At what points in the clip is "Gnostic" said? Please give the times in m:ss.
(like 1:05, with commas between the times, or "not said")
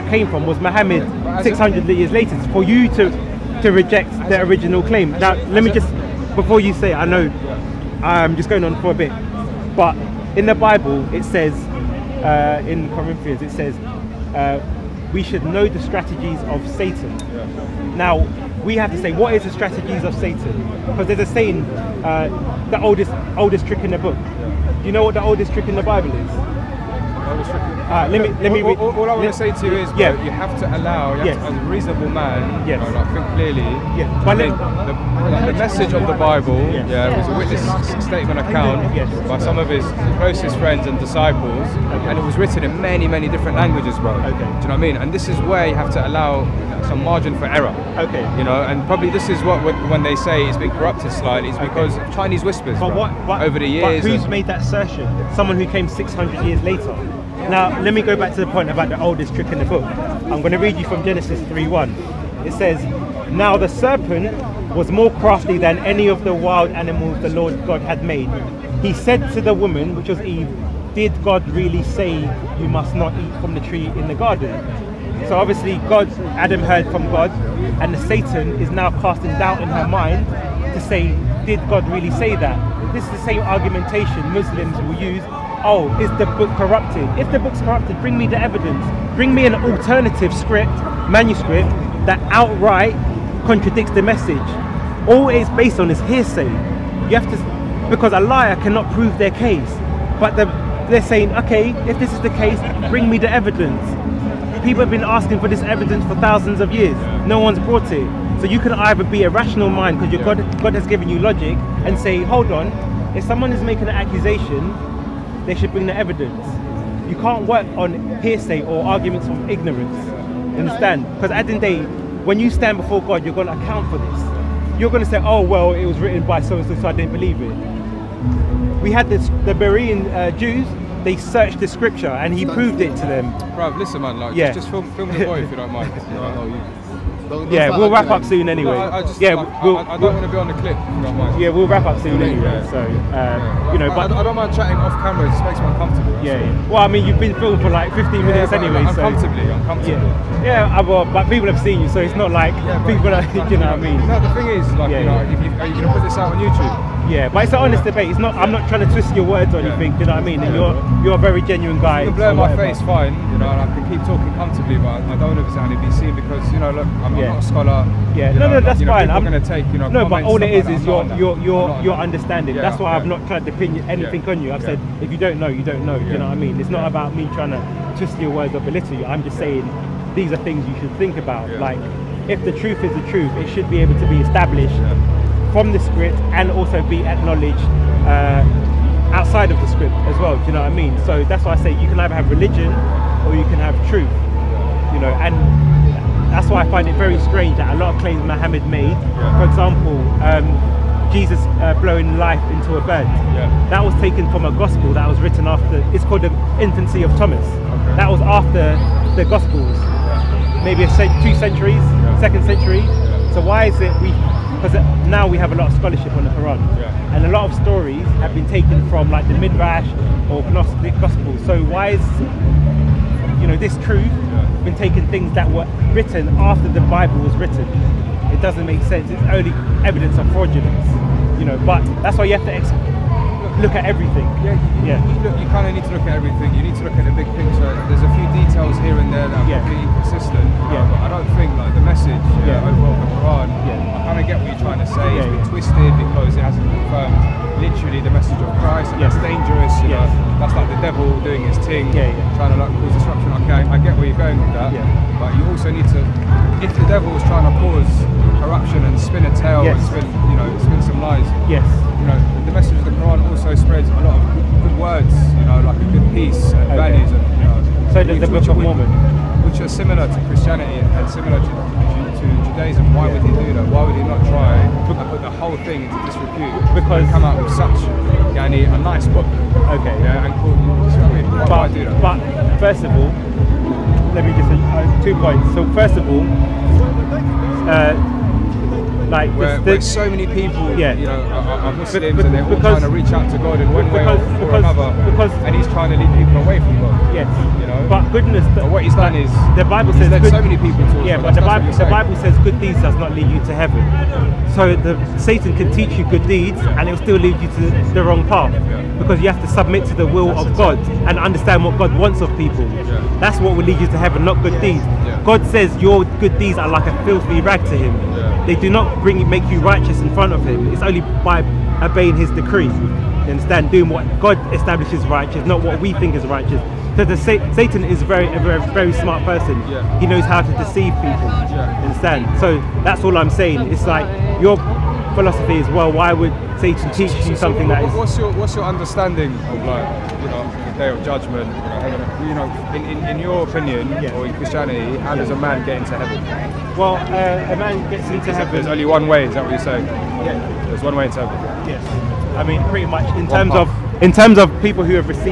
3:40.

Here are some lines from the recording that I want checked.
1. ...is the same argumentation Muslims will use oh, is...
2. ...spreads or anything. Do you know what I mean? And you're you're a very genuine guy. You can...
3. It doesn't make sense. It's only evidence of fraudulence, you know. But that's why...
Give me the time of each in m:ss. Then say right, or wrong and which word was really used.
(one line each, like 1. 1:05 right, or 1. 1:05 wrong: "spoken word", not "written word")
1. 1:23 right
2. 2:39 wrong: "words", not "spreads"
3. 3:48 right.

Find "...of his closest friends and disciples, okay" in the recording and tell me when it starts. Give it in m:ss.
0:39.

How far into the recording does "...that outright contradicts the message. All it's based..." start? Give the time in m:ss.
1:32.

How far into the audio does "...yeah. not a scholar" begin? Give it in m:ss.
2:47.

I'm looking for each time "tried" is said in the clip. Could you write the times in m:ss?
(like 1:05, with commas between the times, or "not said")
2:53.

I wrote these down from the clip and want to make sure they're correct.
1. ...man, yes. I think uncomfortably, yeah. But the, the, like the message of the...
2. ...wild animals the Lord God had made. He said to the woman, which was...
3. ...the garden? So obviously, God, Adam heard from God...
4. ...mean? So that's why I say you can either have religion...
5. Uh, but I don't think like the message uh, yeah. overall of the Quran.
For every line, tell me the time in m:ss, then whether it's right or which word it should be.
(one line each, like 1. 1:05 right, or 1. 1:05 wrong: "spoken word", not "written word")
1. 0:32 wrong: "clearly", not "uncomfortably"
2. 1:06 right
3. 1:14 right
4. 3:10 right
5. 4:00 right.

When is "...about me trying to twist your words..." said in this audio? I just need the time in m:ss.
2:56.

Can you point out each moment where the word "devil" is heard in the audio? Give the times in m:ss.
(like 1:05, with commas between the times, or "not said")
4:10, 4:16.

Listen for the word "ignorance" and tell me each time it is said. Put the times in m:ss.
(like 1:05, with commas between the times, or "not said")
1:59.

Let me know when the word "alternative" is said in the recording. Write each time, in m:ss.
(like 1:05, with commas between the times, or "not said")
1:29.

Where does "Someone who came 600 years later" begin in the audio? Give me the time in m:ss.
0:55.